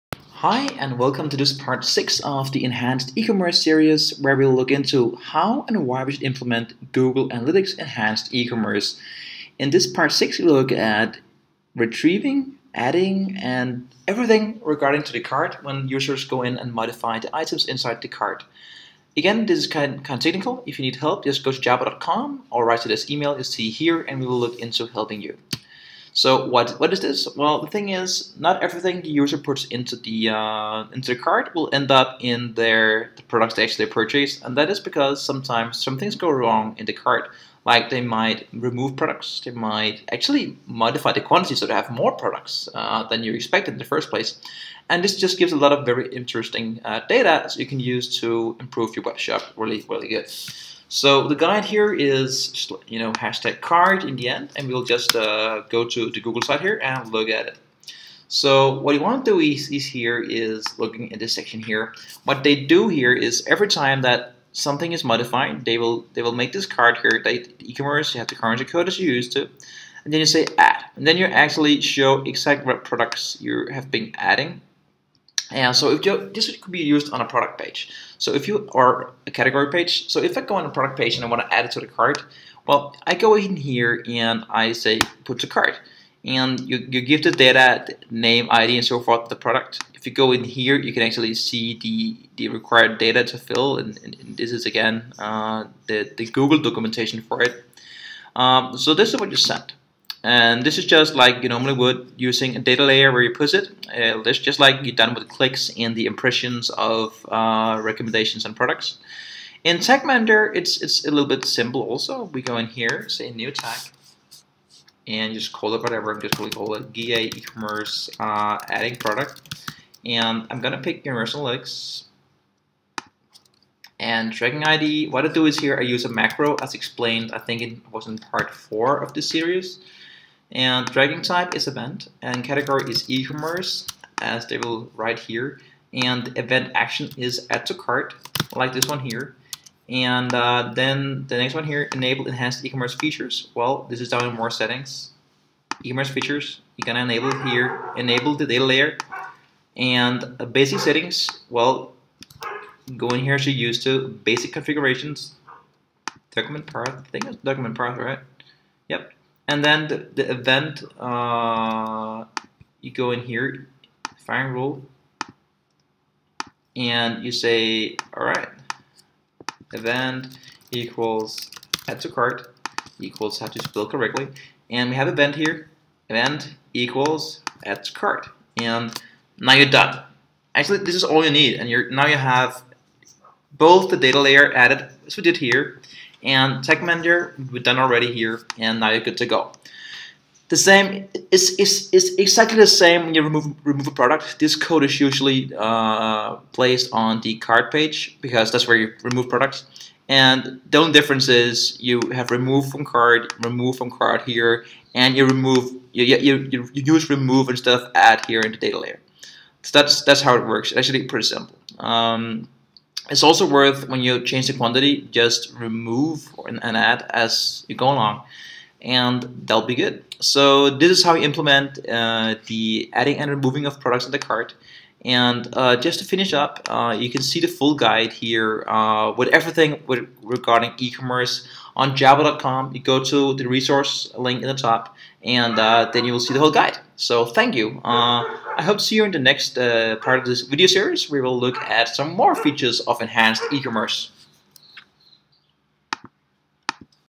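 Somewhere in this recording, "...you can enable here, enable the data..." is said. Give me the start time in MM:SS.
02:26.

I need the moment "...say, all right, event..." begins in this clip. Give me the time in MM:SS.
02:47.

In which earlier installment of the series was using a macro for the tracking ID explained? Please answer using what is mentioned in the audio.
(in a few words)
part 4.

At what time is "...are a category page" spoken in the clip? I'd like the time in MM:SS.
01:18.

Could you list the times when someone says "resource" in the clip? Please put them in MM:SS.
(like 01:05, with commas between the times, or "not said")
03:53.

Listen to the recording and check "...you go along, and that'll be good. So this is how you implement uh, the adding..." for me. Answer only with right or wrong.
right.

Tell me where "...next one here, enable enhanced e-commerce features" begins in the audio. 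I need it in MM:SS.
02:21.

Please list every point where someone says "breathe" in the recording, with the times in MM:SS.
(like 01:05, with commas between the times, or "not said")
not said.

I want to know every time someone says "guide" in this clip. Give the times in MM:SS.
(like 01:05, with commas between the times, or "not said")
00:51, 03:47, 03:56.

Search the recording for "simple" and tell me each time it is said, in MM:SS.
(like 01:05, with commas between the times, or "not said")
01:51, 03:31.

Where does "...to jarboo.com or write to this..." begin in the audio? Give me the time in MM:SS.
00:21.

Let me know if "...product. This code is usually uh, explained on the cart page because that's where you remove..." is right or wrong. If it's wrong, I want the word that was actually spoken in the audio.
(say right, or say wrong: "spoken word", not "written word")
wrong: "placed", not "explained".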